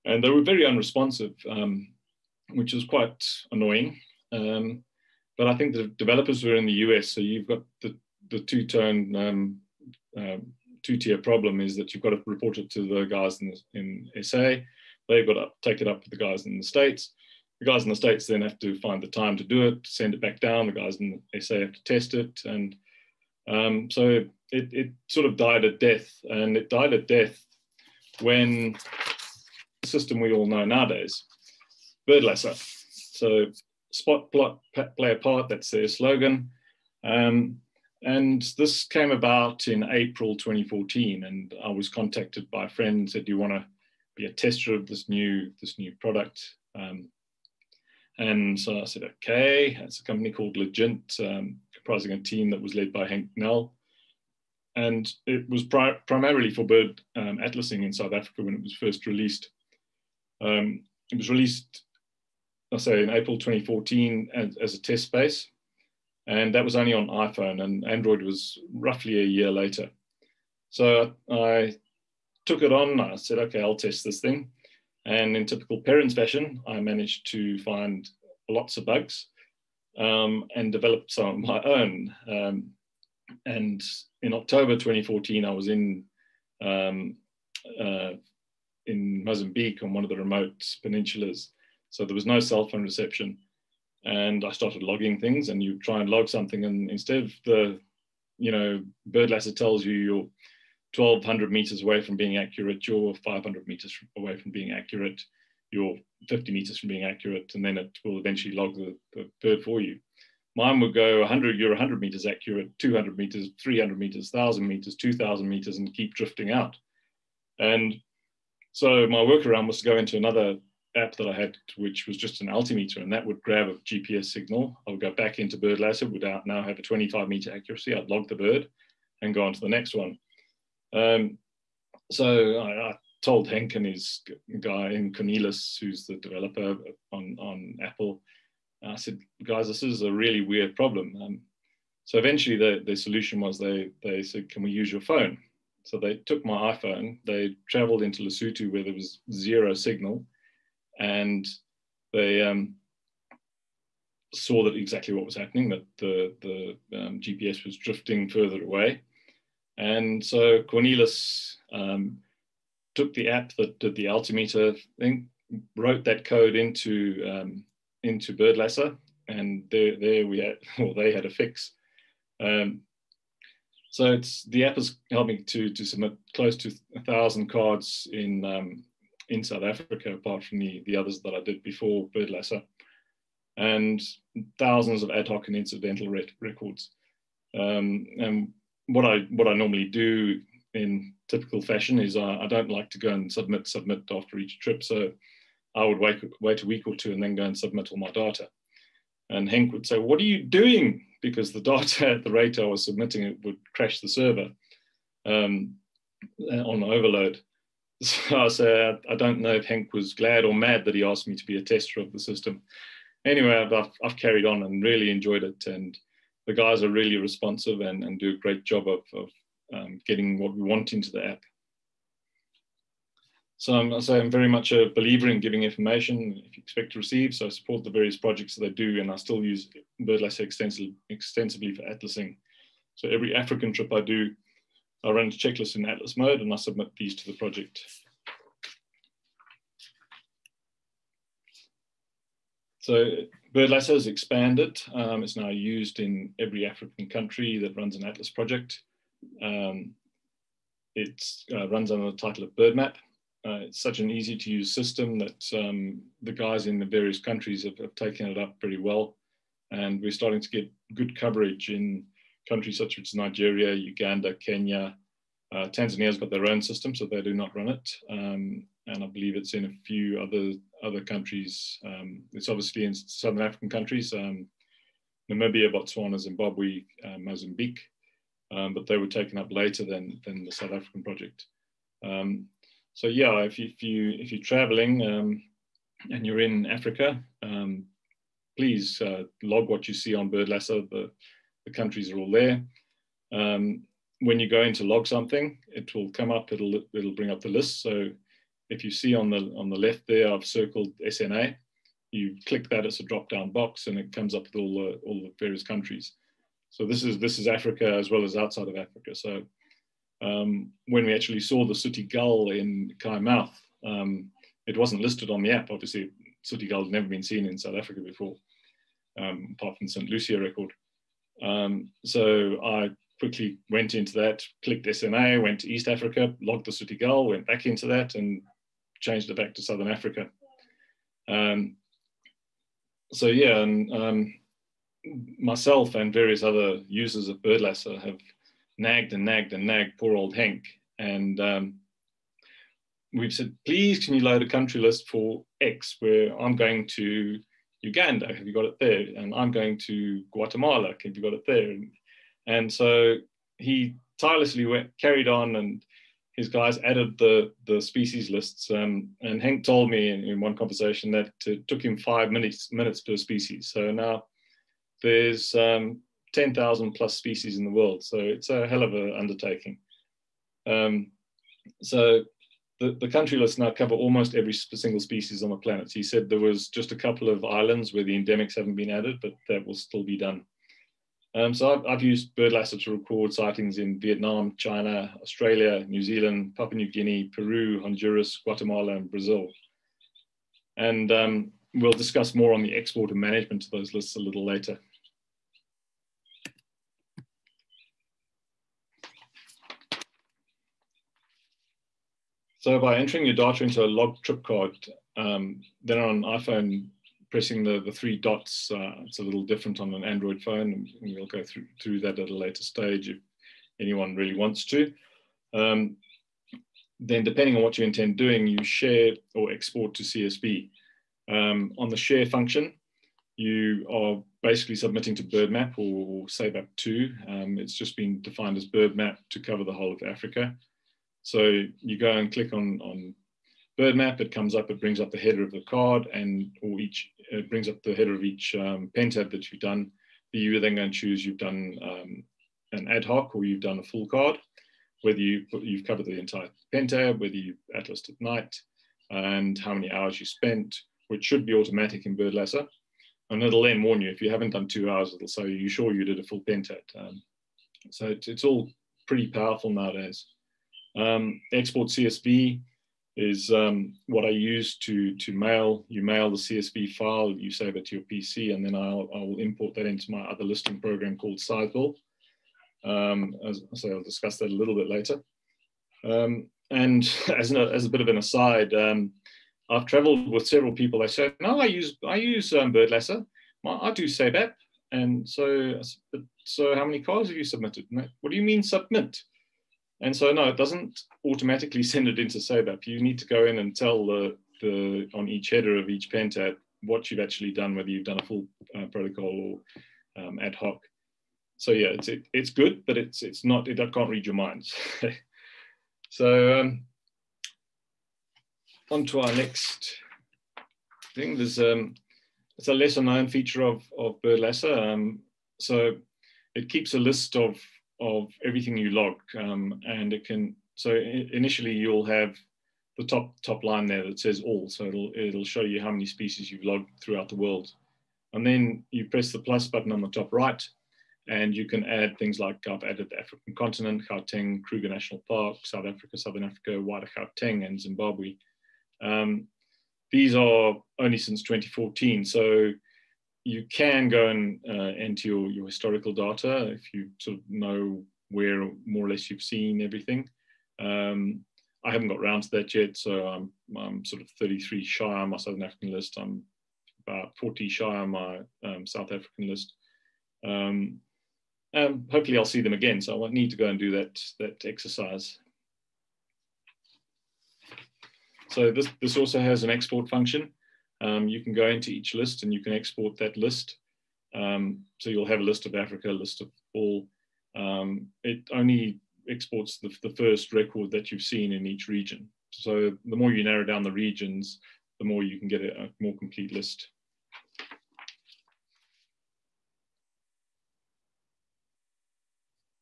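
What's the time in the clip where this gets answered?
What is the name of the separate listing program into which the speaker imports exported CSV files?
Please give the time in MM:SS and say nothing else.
07:51.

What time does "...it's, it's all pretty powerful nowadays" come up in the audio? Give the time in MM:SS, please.
07:38.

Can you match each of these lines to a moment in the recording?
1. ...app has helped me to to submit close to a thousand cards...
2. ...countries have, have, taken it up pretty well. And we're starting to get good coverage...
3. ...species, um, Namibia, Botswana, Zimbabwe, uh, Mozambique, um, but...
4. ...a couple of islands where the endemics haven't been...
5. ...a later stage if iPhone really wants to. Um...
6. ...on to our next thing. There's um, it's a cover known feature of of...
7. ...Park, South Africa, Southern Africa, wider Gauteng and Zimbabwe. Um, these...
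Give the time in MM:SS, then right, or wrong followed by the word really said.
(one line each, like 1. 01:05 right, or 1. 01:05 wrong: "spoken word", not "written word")
1. 02:54 right
2. 04:17 right
3. 04:33 wrong: "countries", not "species"
4. 06:16 right
5. 06:52 wrong: "anyone", not "iPhone"
6. 08:28 wrong: "lesser", not "cover"
7. 08:55 right.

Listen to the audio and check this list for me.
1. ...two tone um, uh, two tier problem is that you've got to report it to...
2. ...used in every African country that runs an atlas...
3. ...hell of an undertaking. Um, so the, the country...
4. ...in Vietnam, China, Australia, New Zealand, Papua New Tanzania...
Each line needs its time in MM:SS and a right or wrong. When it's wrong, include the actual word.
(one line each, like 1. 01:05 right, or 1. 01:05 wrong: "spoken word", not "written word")
1. 00:08 right
2. 04:05 right
3. 06:08 right
4. 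06:23 wrong: "Guinea", not "Tanzania".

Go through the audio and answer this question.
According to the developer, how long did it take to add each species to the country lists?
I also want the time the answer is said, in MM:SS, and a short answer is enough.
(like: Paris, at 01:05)
5 minutes, at 06:01.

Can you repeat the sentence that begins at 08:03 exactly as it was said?
I do SABAP." And so, so how many cars have you submitted?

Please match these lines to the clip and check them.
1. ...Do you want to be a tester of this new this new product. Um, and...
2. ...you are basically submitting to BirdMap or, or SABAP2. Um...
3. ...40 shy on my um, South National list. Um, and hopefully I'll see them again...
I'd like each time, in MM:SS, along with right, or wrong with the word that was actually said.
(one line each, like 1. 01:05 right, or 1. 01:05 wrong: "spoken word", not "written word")
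1. 00:43 right
2. 07:03 right
3. 09:17 wrong: "African", not "National".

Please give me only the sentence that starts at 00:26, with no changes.
And it died a death when the system we all know nowadays, Birdlasser.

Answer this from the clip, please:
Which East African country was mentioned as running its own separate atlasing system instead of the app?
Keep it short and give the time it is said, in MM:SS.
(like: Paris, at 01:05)
Tanzania, at 04:25.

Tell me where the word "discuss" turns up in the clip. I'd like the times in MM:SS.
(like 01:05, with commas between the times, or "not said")
06:31, 07:54.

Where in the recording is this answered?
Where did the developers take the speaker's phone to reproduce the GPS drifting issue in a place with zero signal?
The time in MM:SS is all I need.
02:28.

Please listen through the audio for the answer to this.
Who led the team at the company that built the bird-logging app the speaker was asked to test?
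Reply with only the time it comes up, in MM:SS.
00:53.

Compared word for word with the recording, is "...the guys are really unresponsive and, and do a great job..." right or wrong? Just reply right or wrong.
wrong.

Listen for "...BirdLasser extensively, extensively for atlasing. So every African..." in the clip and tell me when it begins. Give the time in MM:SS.
03:50.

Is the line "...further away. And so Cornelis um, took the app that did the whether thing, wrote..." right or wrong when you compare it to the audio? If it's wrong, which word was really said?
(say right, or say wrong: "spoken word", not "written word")
wrong: "altimeter", not "whether".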